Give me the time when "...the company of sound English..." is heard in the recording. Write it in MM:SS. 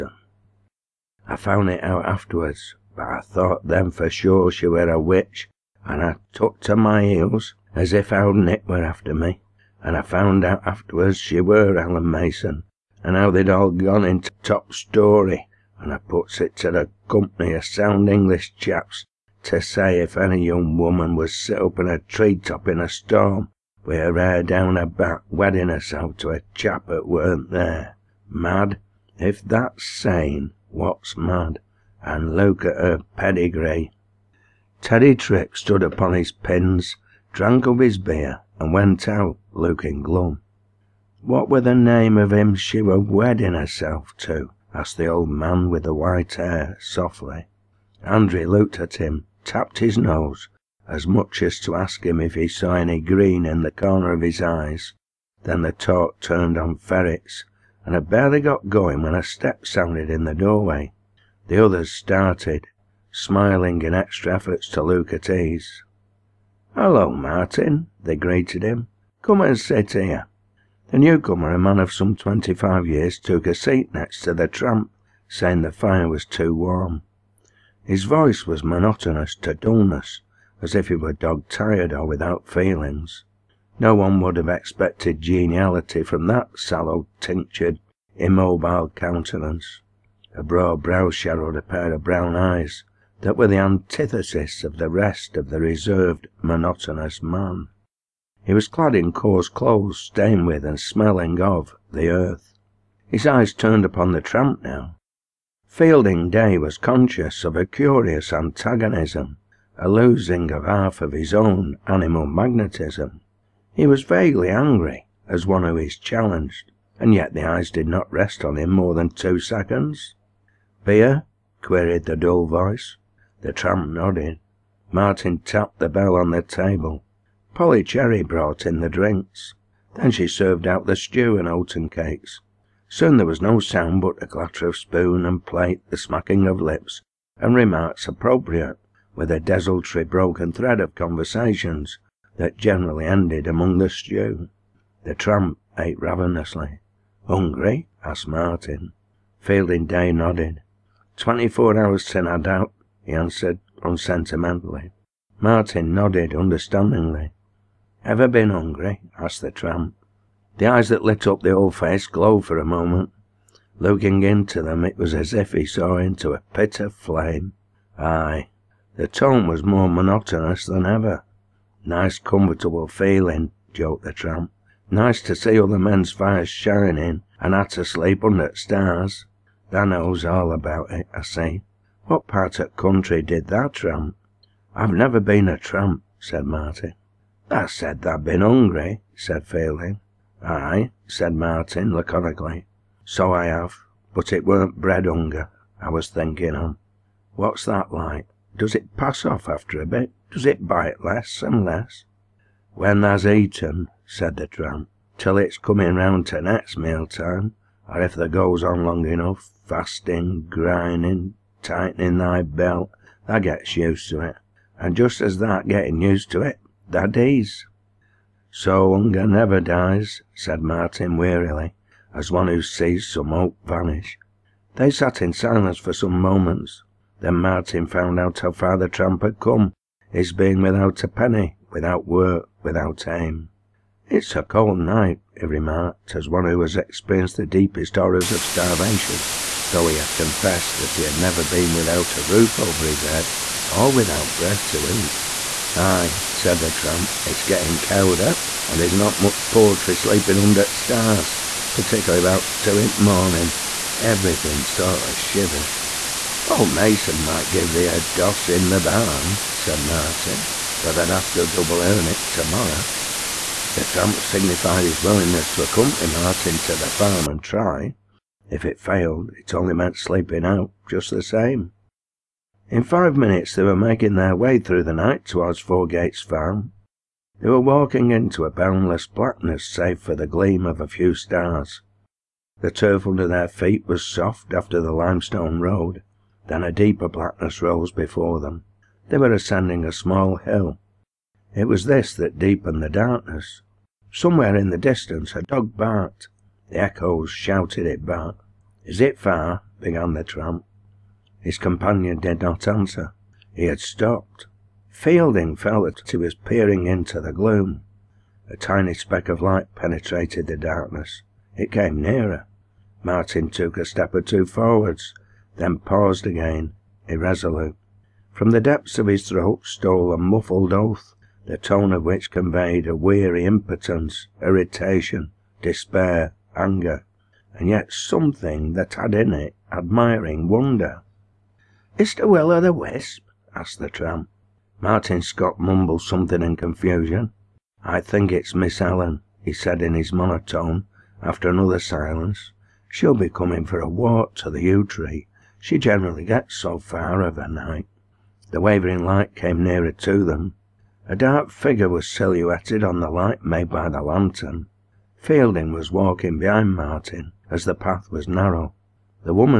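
00:16.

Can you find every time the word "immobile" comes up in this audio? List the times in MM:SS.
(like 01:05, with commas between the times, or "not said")
01:28.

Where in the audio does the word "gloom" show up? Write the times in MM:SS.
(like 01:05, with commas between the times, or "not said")
05:07.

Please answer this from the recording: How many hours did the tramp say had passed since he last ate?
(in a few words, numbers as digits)
24.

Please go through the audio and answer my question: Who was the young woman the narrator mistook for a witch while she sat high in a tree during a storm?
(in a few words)
Ellen Mason.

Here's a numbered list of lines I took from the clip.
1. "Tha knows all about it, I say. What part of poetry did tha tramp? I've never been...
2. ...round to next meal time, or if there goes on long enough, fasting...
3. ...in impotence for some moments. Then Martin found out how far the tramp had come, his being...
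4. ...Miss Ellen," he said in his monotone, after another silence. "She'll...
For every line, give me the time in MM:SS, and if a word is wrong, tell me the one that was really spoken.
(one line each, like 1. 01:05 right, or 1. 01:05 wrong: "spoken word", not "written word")
1. 02:59 wrong: "country", not "poetry"
2. 03:25 right
3. 03:45 wrong: "silence", not "impotence"
4. 05:38 right.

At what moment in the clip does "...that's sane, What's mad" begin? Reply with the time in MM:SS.
00:29.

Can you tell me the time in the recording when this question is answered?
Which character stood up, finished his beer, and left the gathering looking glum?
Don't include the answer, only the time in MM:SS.
00:34.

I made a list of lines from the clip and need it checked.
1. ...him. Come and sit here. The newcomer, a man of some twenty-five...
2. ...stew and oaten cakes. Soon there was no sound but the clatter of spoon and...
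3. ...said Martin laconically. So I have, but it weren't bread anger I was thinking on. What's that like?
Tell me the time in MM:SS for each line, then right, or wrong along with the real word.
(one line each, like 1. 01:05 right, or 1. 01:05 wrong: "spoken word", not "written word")
1. 01:08 right
2. 02:10 right
3. 03:11 wrong: "hunger", not "anger".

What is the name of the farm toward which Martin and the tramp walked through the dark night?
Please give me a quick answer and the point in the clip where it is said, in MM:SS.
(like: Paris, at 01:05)
Fourgates Farm, at 04:35.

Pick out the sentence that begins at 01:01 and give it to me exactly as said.
The others started, smiling in extra efforts to look at ease.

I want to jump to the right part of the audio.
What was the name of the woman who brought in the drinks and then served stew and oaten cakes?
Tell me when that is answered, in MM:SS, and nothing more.
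02:07.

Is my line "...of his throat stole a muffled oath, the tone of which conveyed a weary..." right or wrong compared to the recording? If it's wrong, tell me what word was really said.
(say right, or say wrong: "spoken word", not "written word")
right.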